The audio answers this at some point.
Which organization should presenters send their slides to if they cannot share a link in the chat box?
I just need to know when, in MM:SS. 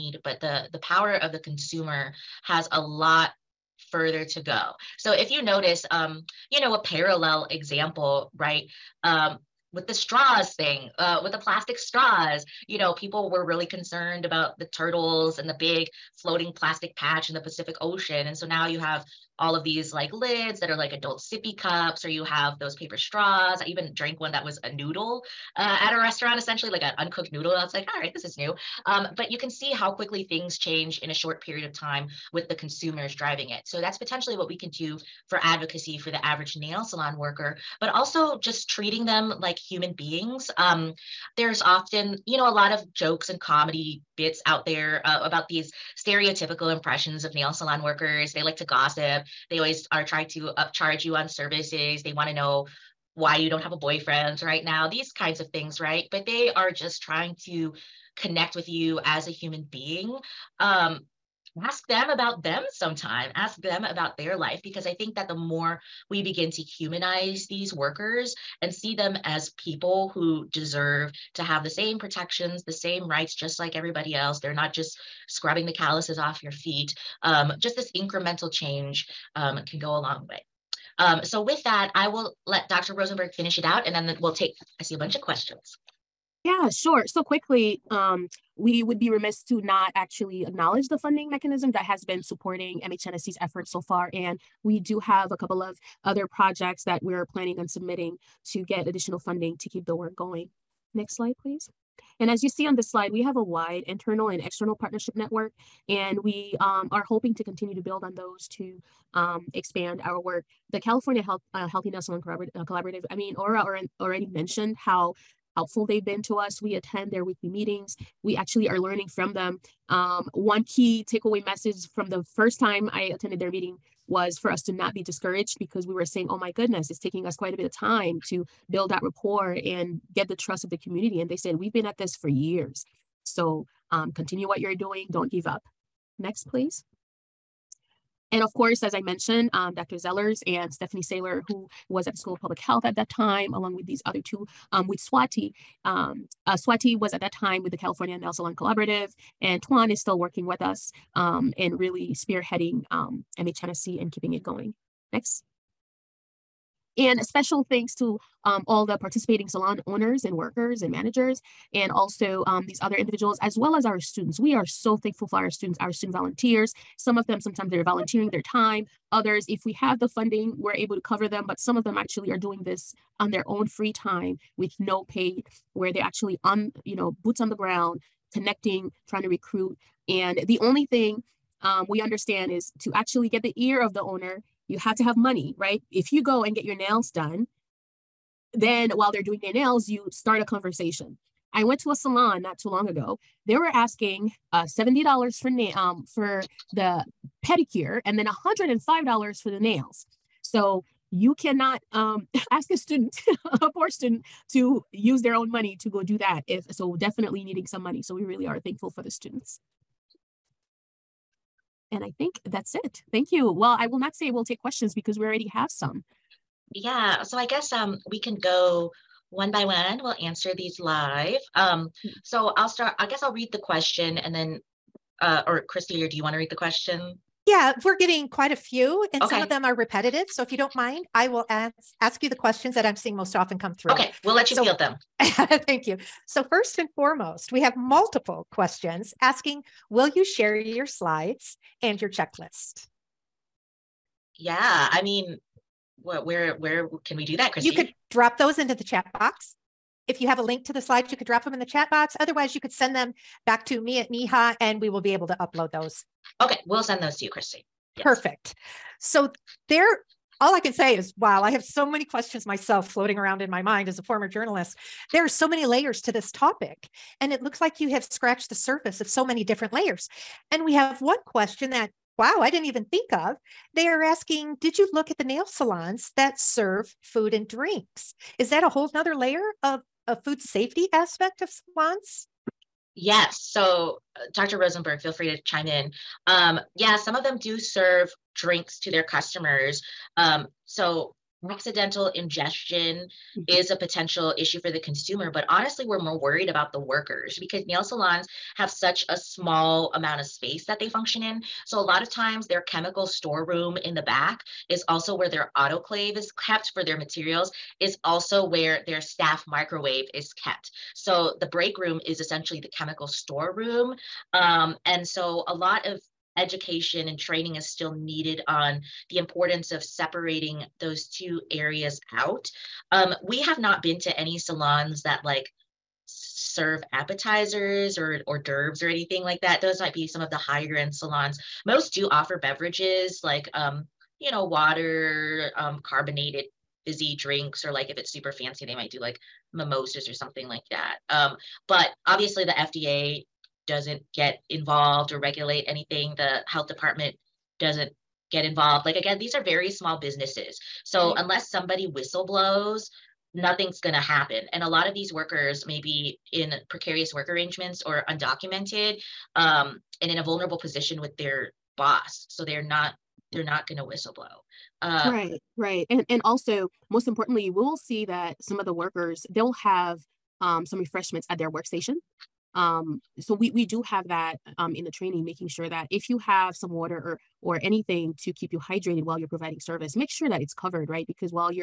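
04:14.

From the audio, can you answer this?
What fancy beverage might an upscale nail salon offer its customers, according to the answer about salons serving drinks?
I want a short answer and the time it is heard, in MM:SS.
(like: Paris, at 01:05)
mimosas, at 05:39.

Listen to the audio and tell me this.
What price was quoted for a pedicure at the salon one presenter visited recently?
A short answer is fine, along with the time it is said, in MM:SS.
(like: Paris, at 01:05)
$70, at 03:14.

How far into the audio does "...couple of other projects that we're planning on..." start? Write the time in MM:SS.
01:35.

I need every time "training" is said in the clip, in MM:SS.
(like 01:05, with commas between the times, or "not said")
05:17, 06:14.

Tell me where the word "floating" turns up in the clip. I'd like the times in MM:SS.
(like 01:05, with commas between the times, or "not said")
00:16, 04:22.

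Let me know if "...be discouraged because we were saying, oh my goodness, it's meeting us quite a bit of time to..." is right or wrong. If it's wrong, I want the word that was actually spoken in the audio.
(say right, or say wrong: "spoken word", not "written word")
wrong: "taking", not "meeting".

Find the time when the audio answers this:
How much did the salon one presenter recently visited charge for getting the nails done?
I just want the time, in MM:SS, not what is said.
03:18.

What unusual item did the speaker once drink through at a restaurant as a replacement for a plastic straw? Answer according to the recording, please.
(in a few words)
uncooked noodle.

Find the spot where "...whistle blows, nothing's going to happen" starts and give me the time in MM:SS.
05:51.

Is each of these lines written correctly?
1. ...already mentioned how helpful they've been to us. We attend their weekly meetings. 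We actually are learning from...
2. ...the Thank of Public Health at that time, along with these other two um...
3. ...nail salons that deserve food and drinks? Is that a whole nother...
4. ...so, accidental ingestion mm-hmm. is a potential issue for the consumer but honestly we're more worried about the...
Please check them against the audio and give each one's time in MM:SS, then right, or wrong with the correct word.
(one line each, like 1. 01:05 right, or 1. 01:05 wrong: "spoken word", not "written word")
1. 01:54 right
2. 02:22 wrong: "School", not "Thank"
3. 04:35 wrong: "serve", not "deserve"
4. 04:50 right.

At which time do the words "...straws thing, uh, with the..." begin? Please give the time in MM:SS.
00:09.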